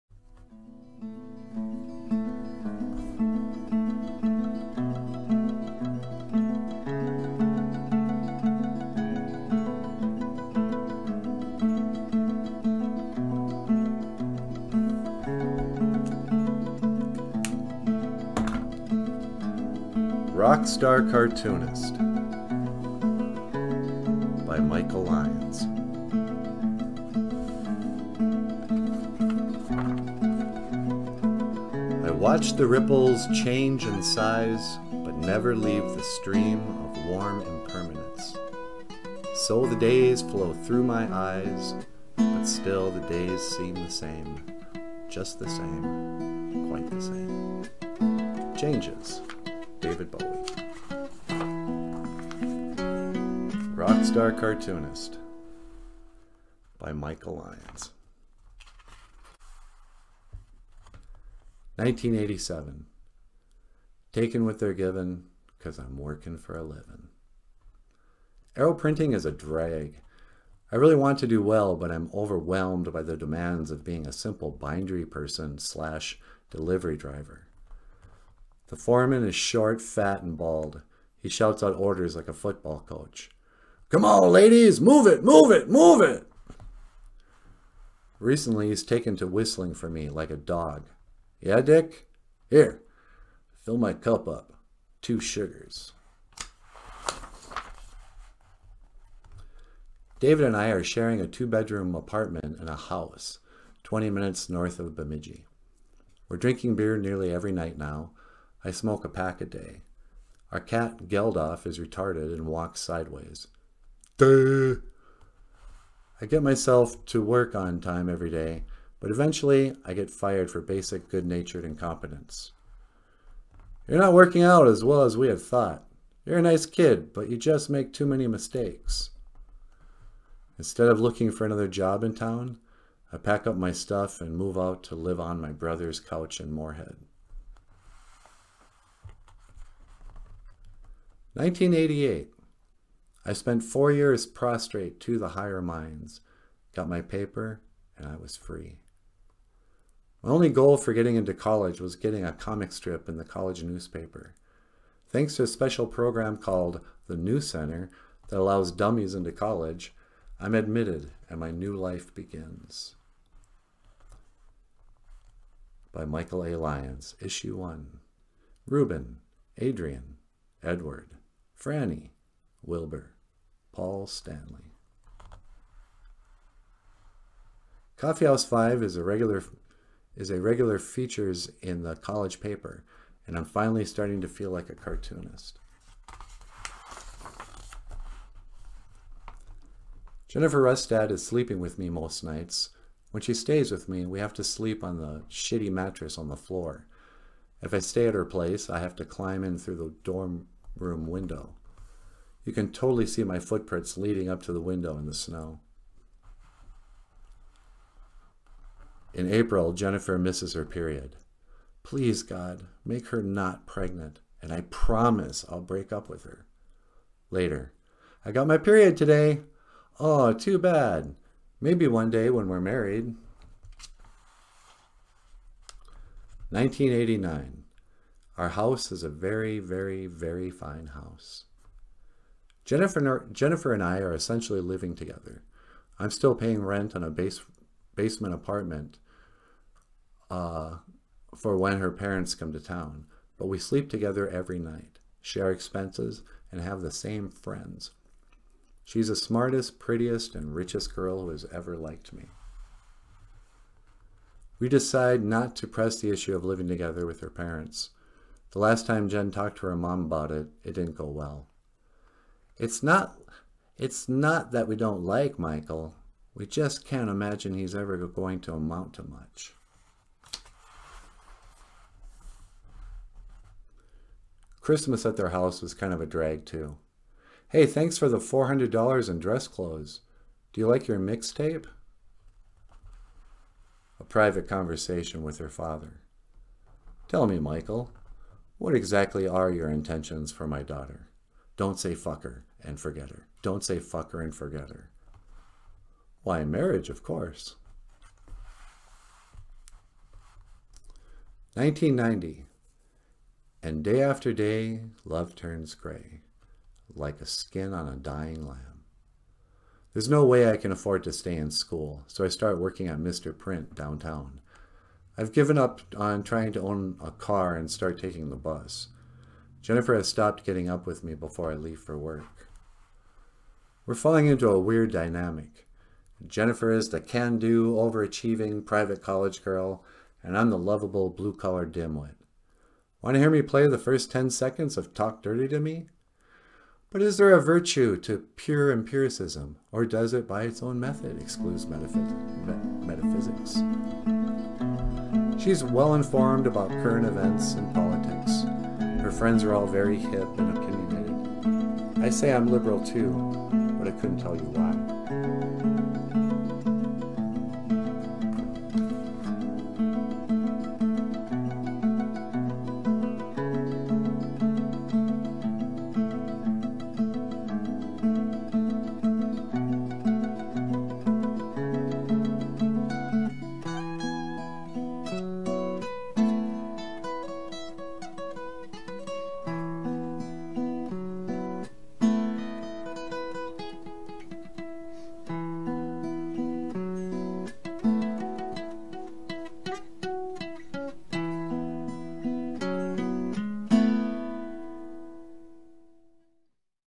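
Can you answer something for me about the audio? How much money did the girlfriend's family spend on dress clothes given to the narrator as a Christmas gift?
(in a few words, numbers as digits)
$400.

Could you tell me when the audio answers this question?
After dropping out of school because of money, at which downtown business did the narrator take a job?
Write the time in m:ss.
5:12.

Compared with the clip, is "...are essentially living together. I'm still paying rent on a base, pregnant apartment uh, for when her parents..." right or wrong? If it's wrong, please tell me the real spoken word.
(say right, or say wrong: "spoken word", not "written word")
wrong: "basement", not "pregnant".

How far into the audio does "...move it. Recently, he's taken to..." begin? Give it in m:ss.
1:25.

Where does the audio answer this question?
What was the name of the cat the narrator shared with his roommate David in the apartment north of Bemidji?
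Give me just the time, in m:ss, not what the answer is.
1:51.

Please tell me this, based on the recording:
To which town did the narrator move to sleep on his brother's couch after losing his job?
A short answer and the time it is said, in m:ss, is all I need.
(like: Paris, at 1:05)
Moorhead, at 2:16.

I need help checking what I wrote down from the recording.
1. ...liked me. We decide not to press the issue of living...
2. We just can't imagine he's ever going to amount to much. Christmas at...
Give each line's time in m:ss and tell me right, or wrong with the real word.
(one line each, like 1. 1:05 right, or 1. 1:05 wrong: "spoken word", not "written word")
1. 4:11 right
2. 4:26 right.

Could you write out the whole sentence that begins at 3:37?
Later, I got my period today.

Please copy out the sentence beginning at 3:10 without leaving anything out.
Jennifer Rustad is sleeping with me most nights.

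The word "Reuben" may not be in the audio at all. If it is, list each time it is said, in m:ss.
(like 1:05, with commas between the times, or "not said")
2:48.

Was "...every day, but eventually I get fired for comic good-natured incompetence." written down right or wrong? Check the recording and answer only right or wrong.
wrong.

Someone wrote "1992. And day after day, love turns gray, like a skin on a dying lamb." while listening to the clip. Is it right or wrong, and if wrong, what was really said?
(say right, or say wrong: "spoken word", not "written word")
wrong: "1990", not "1992".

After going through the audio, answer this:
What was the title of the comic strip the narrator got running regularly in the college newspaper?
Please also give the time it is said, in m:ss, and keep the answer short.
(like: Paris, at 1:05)
Coffeehouse Five, at 2:57.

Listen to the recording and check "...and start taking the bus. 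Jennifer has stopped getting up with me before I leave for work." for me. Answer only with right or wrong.
right.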